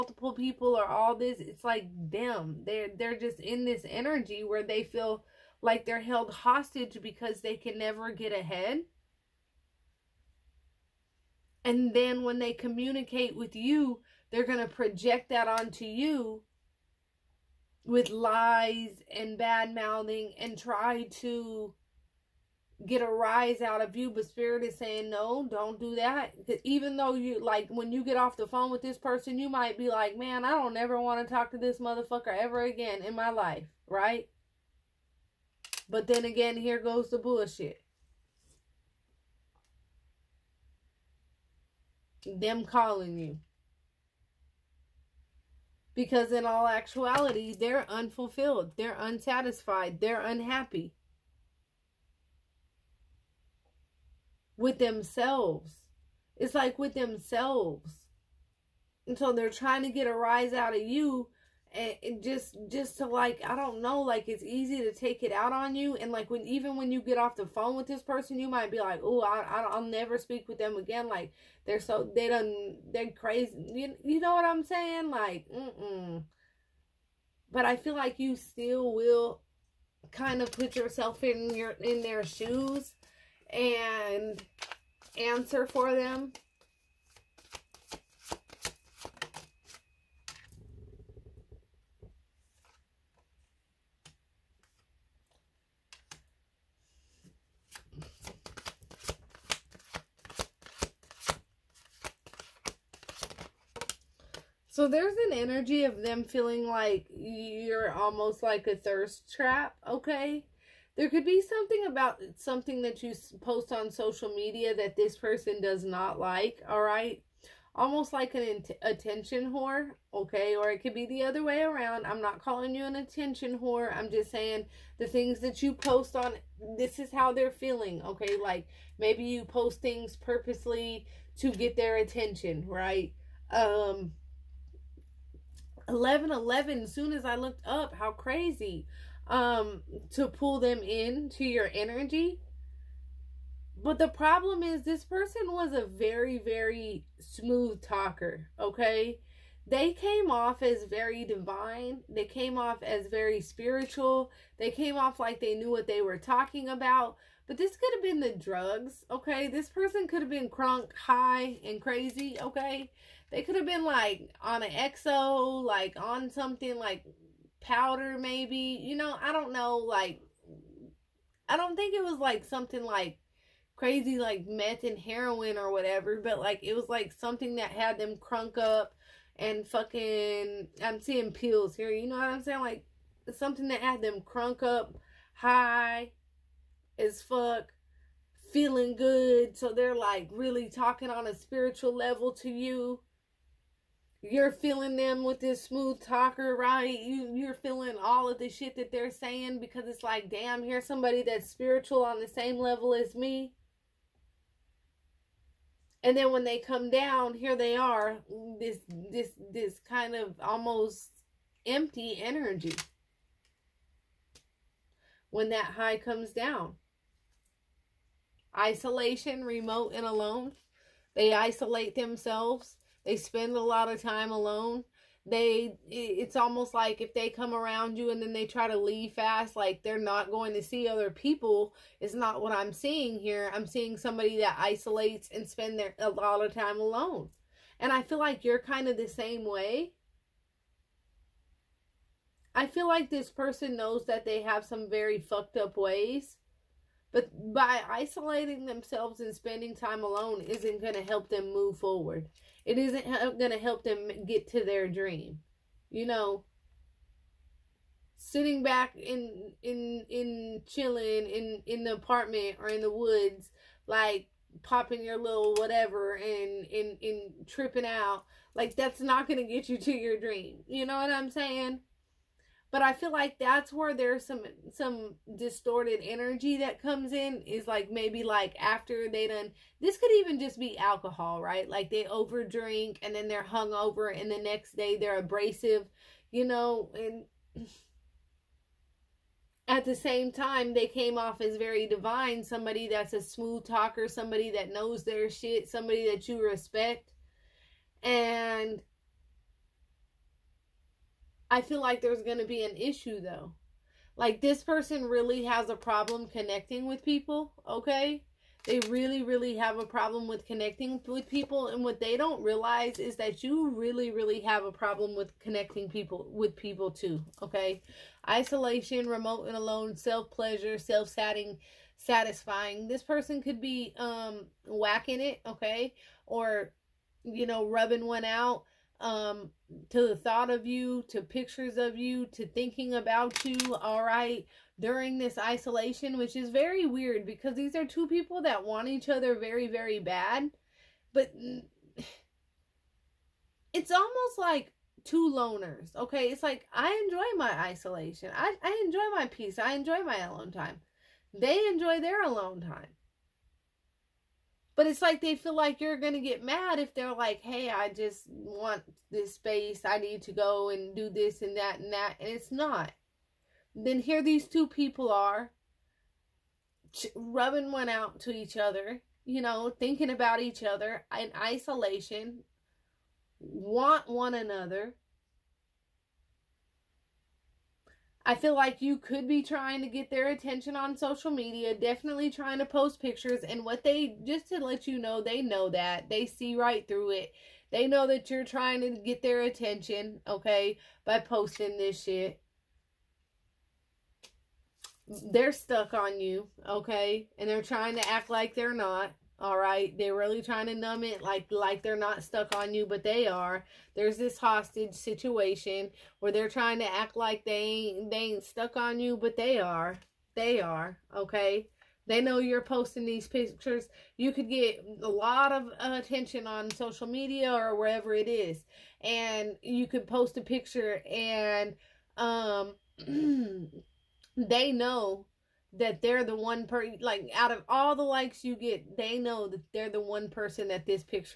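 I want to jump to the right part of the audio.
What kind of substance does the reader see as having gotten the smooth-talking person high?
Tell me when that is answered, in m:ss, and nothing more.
3:01.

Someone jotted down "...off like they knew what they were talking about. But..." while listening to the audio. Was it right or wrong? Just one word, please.
right.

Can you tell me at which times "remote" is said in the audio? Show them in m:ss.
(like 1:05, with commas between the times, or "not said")
3:39, 5:19.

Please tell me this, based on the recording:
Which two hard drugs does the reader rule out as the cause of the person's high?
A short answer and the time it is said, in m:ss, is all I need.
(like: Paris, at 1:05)
meth and heroin, at 2:54.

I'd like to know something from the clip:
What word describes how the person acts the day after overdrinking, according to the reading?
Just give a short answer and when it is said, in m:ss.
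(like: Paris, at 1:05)
abrasive, at 4:45.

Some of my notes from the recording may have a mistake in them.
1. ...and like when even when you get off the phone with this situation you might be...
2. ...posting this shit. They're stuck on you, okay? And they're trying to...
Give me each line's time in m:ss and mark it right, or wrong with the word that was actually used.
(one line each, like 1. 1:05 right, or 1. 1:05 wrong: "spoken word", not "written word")
1. 1:05 wrong: "person", not "situation"
2. 6:31 right.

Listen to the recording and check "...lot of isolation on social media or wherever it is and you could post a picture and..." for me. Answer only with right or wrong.
wrong.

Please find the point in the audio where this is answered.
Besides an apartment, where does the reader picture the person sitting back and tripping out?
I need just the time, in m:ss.
4:22.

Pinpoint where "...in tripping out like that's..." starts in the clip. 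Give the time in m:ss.
4:27.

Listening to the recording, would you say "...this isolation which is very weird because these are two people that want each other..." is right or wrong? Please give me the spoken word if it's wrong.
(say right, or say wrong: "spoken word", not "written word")
right.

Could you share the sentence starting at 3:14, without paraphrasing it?
You're feeling them with this smooth talker, right?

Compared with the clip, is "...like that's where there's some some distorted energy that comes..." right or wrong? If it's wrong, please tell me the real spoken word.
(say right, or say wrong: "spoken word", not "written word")
right.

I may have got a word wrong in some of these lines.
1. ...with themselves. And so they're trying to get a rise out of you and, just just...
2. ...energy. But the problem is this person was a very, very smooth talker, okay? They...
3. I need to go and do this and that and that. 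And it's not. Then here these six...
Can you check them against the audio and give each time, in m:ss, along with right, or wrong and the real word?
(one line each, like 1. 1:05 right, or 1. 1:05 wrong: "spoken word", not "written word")
1. 0:56 right
2. 2:21 right
3. 5:59 wrong: "two", not "six".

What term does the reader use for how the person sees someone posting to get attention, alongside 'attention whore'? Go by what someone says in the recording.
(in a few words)
thirst trap.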